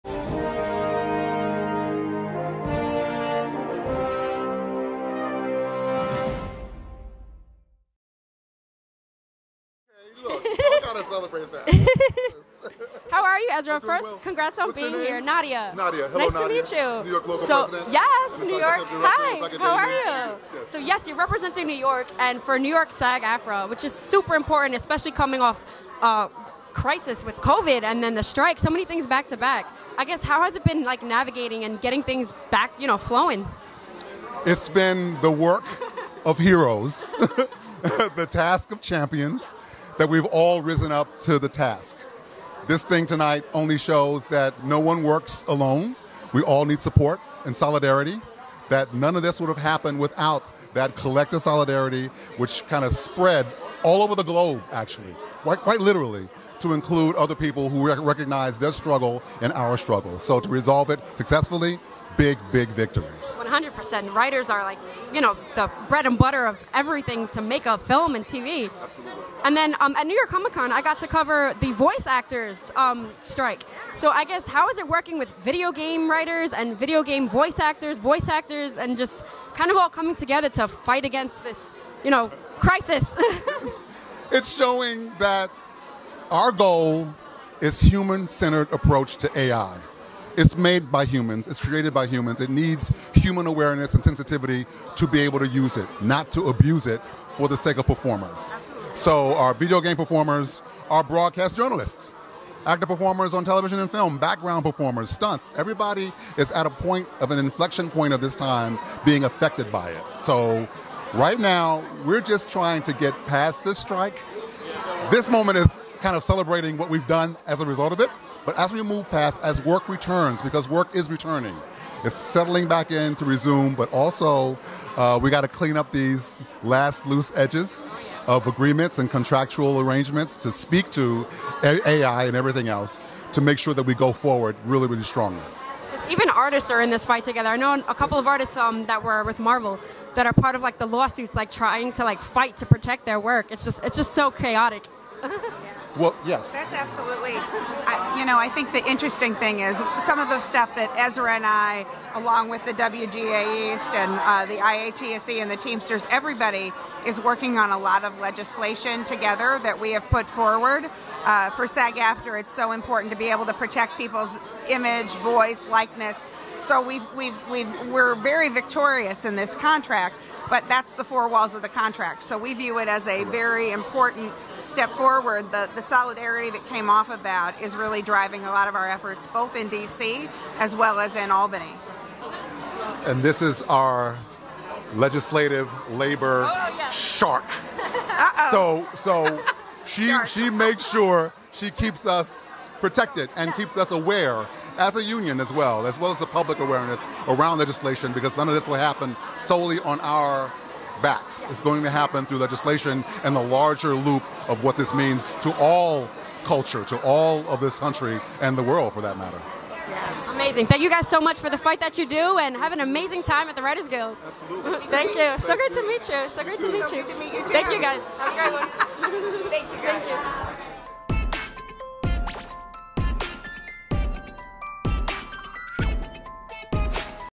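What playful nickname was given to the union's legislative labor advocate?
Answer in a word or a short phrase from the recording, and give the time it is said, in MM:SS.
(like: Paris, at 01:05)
she shark, at 03:09.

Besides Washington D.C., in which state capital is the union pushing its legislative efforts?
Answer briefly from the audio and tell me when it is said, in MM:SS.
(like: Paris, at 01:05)
Albany, at 03:01.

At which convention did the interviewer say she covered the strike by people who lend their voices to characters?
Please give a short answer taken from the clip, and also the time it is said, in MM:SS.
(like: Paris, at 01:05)
New York Comic Con, at 01:10.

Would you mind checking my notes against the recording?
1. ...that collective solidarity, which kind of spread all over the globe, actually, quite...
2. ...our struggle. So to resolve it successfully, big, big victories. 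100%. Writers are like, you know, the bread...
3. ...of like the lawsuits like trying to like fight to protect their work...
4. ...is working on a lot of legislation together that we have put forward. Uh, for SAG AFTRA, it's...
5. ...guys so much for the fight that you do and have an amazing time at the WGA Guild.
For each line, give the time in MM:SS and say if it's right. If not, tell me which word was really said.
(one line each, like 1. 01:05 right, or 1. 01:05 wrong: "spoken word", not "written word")
1. 00:50 right
2. 00:59 right
3. 02:20 right
4. 02:37 right
5. 03:30 wrong: "Writers", not "WGA".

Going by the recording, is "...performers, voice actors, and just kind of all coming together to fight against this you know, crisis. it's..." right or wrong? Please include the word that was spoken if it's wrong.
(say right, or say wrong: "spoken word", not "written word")
wrong: "actors", not "performers".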